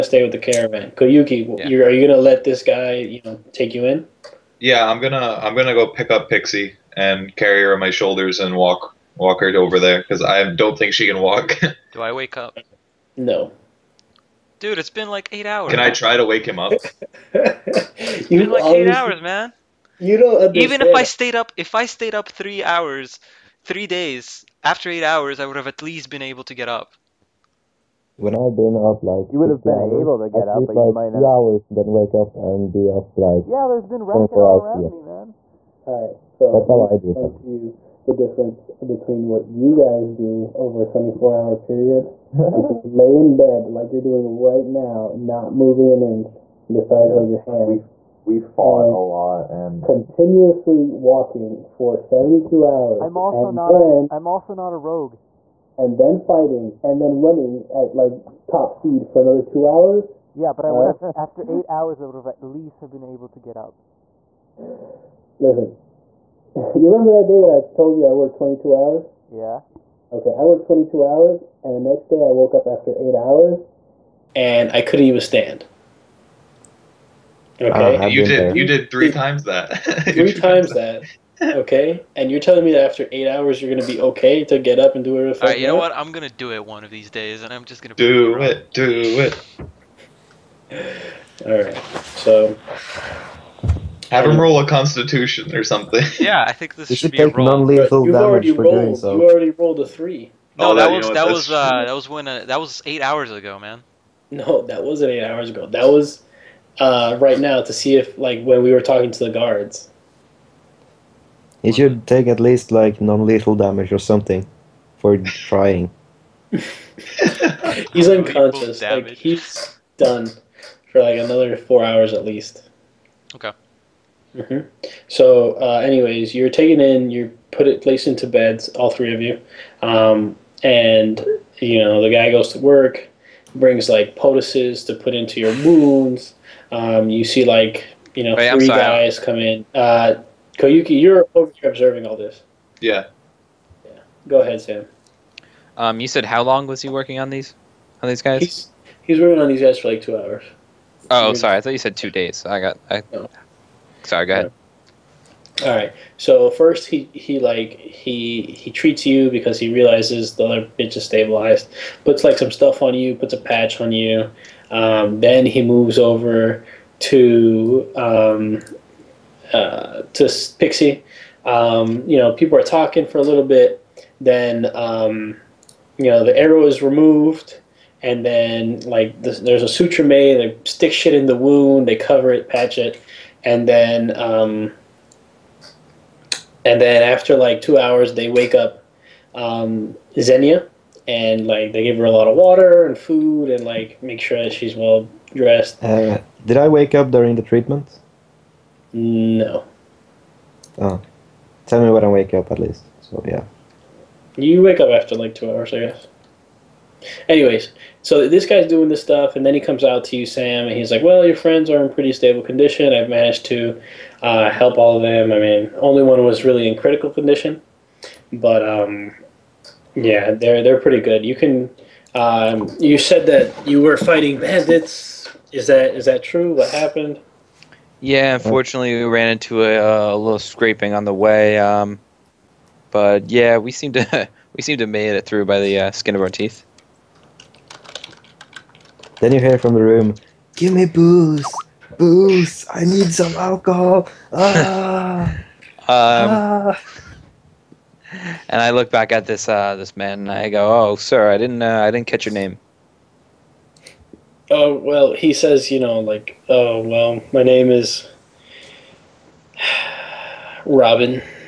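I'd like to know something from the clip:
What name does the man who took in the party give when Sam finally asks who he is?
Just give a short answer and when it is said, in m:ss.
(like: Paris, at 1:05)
Robin, at 4:20.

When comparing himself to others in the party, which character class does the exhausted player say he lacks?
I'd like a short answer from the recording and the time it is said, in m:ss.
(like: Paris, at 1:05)
rogue, at 0:54.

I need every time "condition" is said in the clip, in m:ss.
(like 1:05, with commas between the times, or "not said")
3:32, 3:37.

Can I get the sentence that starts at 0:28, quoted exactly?
When I've been up like you would have been hours, able to get up, but like you might two have...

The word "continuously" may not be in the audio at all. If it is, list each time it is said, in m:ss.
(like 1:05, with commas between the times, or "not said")
0:49.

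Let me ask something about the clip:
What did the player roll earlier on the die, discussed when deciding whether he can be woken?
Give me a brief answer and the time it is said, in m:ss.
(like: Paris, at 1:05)
3, at 1:39.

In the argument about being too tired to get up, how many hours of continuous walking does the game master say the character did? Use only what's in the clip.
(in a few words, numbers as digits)
72.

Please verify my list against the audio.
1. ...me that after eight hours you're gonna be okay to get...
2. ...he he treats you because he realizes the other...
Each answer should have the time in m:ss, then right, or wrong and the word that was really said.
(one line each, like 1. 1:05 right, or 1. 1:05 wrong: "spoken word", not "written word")
1. 1:22 right
2. 2:37 right.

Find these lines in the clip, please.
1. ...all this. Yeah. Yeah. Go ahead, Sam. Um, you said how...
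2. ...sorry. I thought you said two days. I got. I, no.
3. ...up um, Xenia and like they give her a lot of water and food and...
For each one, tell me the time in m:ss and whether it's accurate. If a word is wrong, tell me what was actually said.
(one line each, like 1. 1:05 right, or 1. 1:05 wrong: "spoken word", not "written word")
1. 2:22 right
2. 2:31 right
3. 3:08 right.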